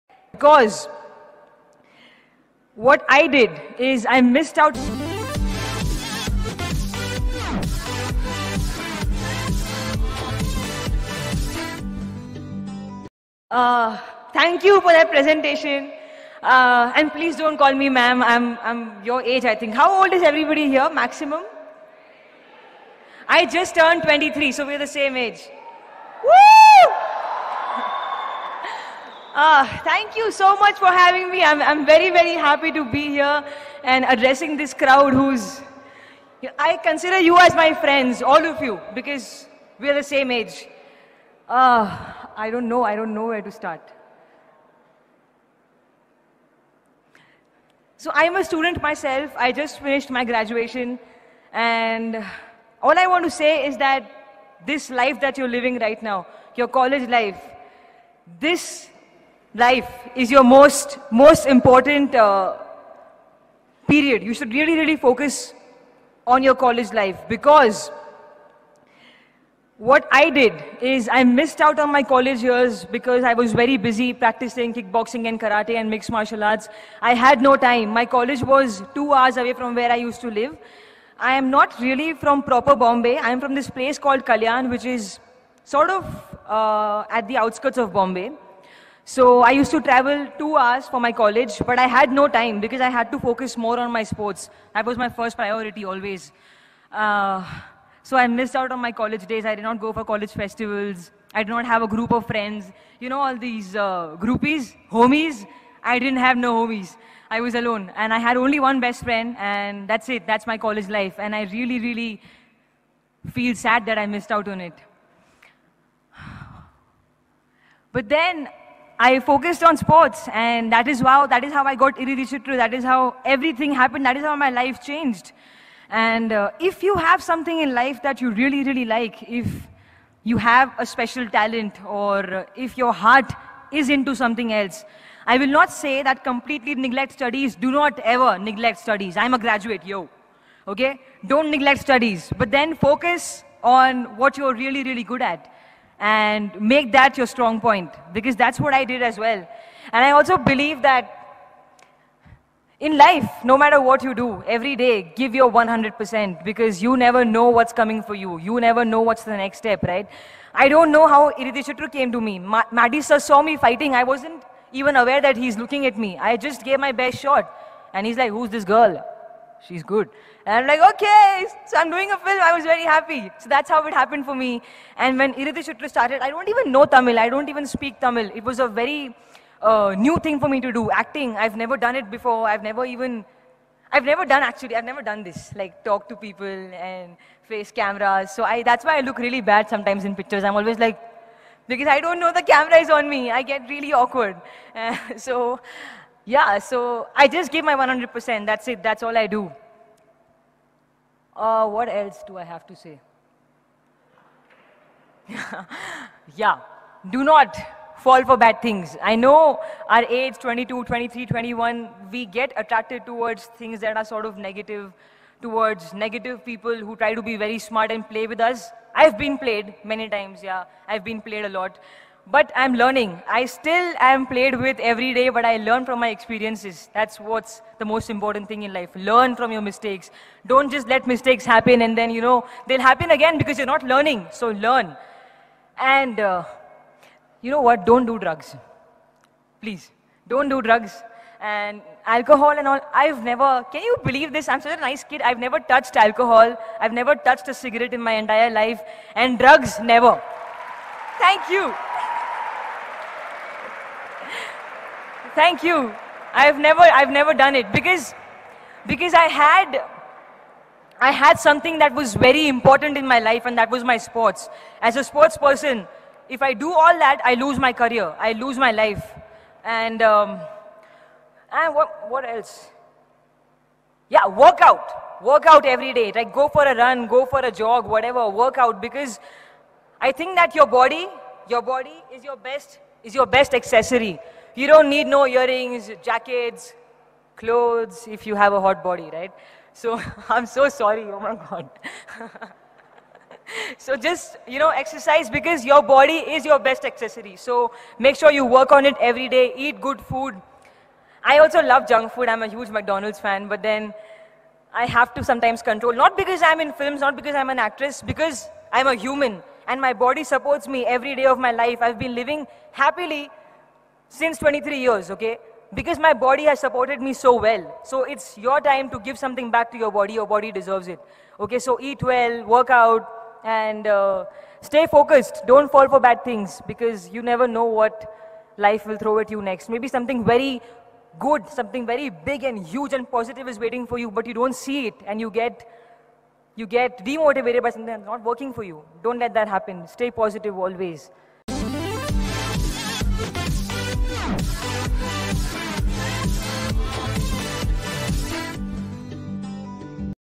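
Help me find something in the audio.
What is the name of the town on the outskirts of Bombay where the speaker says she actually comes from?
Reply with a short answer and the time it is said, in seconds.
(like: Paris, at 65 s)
Kalyan, at 84 s.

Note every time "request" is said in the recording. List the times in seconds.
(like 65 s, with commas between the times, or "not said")
not said.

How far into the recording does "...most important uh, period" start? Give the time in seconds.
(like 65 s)
61 s.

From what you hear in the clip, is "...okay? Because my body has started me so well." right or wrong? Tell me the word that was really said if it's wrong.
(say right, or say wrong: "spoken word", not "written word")
wrong: "supported", not "started".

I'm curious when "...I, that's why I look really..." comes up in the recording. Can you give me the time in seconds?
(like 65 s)
188 s.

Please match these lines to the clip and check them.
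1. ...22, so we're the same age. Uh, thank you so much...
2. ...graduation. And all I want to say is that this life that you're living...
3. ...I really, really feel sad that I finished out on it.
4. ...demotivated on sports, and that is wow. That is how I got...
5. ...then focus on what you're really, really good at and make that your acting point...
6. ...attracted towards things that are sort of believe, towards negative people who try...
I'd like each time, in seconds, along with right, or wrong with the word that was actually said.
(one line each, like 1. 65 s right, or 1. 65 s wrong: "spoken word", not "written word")
1. 24 s wrong: "23", not "22"
2. 50 s right
3. 111 s wrong: "missed", not "finished"
4. 119 s wrong: "focused", not "demotivated"
5. 142 s wrong: "strong", not "acting"
6. 212 s wrong: "negative", not "believe".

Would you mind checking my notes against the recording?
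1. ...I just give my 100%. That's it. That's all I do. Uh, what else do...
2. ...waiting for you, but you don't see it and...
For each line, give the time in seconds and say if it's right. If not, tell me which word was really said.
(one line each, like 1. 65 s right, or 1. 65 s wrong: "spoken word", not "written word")
1. 197 s right
2. 333 s right.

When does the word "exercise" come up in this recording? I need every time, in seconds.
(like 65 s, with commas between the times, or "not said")
294 s.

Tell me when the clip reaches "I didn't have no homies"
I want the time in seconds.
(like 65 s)
105 s.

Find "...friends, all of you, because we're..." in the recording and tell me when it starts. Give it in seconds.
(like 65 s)
37 s.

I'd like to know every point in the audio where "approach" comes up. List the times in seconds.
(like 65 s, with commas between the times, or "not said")
not said.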